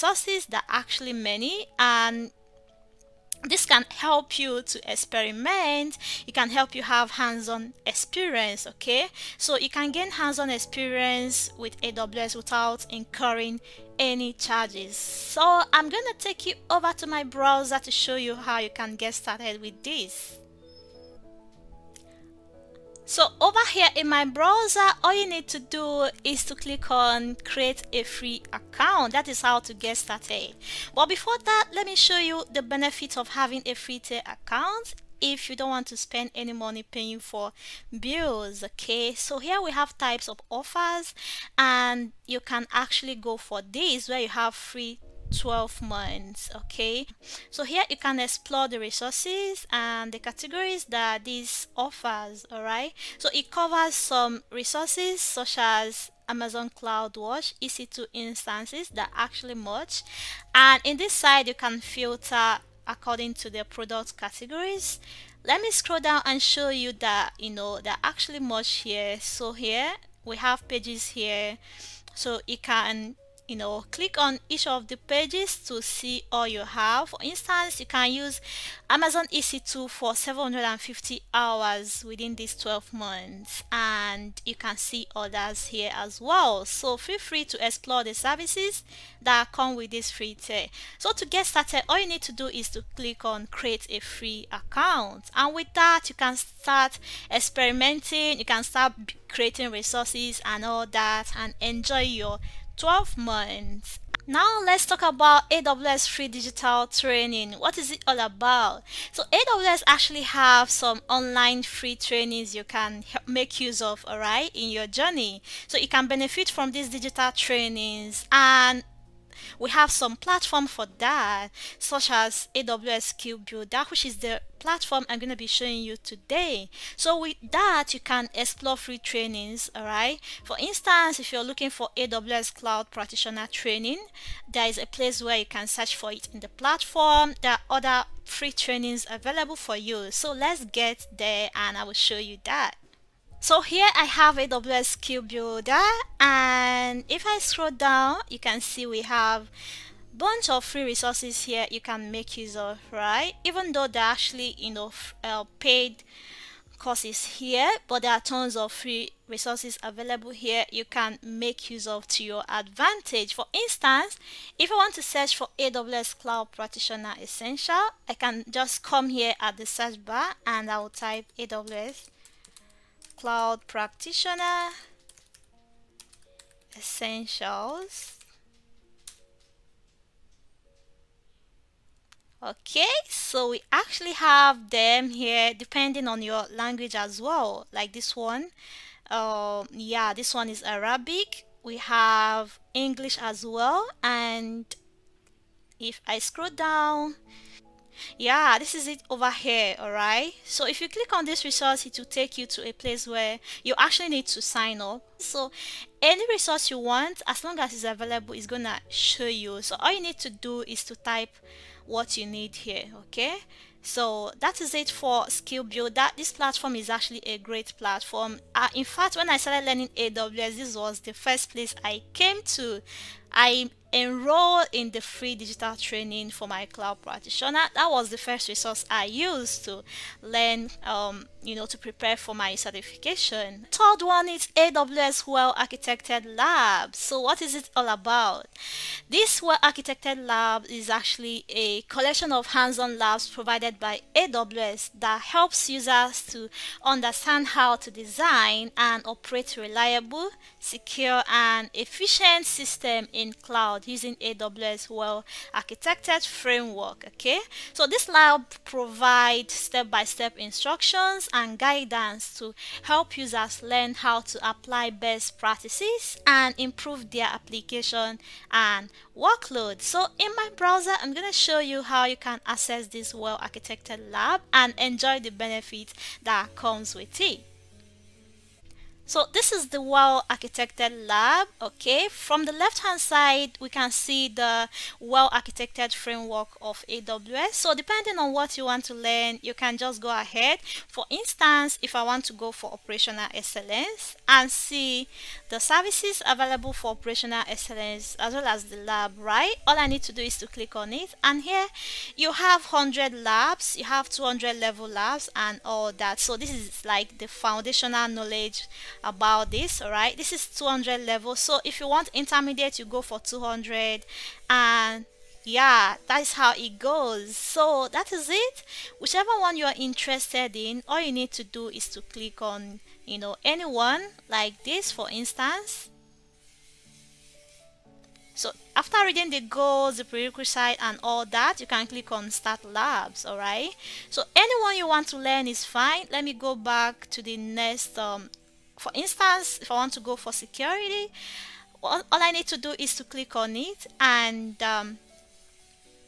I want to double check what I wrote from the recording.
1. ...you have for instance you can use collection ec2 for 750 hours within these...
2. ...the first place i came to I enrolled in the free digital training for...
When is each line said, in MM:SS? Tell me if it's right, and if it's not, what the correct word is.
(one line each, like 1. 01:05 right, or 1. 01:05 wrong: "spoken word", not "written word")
1. 01:16 wrong: "amazon", not "collection"
2. 03:40 right.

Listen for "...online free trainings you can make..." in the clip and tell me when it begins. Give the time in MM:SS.
01:51.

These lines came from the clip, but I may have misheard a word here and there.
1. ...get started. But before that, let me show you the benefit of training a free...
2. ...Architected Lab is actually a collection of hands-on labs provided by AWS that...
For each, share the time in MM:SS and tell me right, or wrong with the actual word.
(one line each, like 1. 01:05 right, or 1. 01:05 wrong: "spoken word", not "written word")
1. 00:29 wrong: "having", not "training"
2. 03:59 right.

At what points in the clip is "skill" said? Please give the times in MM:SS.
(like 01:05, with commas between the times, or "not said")
02:03, 02:24, 03:35.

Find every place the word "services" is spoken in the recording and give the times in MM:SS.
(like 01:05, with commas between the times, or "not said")
01:28, 04:55.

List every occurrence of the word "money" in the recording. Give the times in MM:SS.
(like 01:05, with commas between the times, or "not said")
00:36.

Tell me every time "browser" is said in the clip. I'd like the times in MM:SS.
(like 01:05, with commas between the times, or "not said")
00:17, 00:24, 04:30.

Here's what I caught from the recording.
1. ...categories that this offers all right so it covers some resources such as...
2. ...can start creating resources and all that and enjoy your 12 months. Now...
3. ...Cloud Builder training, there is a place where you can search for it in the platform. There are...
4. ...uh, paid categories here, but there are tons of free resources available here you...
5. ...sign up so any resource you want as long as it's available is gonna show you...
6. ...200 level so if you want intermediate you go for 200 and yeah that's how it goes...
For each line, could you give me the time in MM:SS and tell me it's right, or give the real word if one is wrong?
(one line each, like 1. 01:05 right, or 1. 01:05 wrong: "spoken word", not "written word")
1. 00:50 right
2. 01:38 right
3. 02:12 wrong: "Practitioner", not "Builder"
4. 02:35 wrong: "courses", not "categories"
5. 03:24 right
6. 05:10 right.